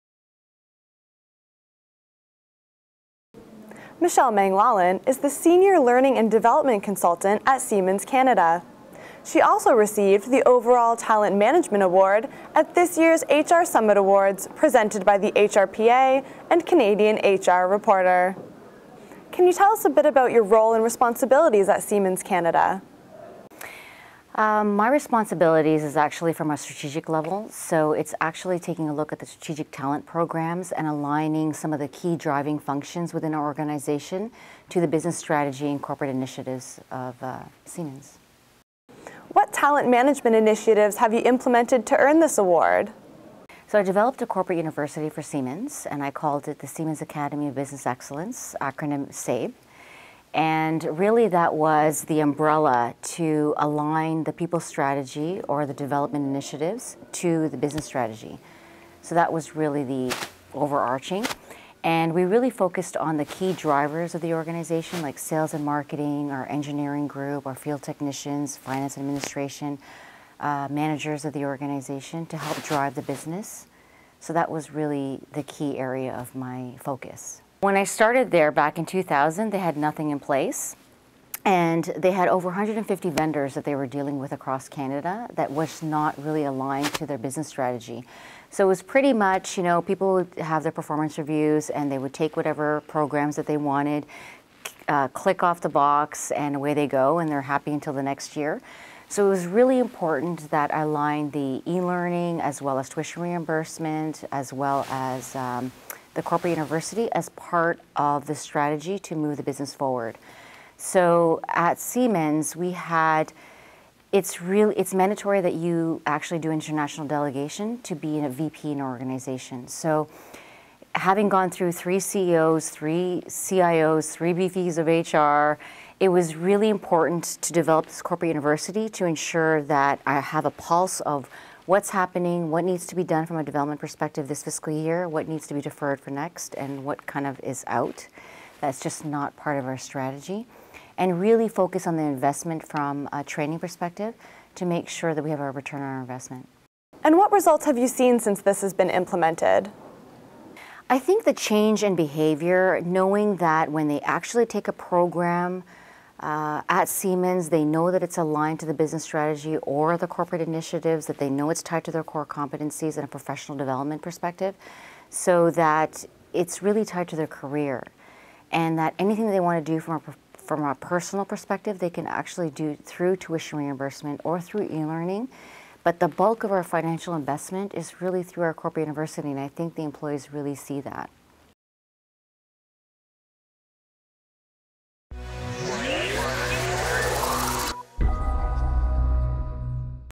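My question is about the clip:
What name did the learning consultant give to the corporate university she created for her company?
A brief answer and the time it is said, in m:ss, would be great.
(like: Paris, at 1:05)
Siemens Academy of Business Excellence, at 0:46.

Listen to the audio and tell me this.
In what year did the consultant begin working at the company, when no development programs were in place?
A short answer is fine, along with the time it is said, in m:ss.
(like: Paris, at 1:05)
2000, at 1:18.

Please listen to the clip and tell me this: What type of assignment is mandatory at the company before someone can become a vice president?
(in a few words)
international delegation.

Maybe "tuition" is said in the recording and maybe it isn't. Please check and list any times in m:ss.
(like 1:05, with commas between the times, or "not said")
1:42, 2:53.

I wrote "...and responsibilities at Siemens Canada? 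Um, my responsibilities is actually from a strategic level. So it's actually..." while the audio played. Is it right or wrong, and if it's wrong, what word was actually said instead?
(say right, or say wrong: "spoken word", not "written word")
right.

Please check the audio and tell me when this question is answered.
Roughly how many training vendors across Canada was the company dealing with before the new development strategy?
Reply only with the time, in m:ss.
1:22.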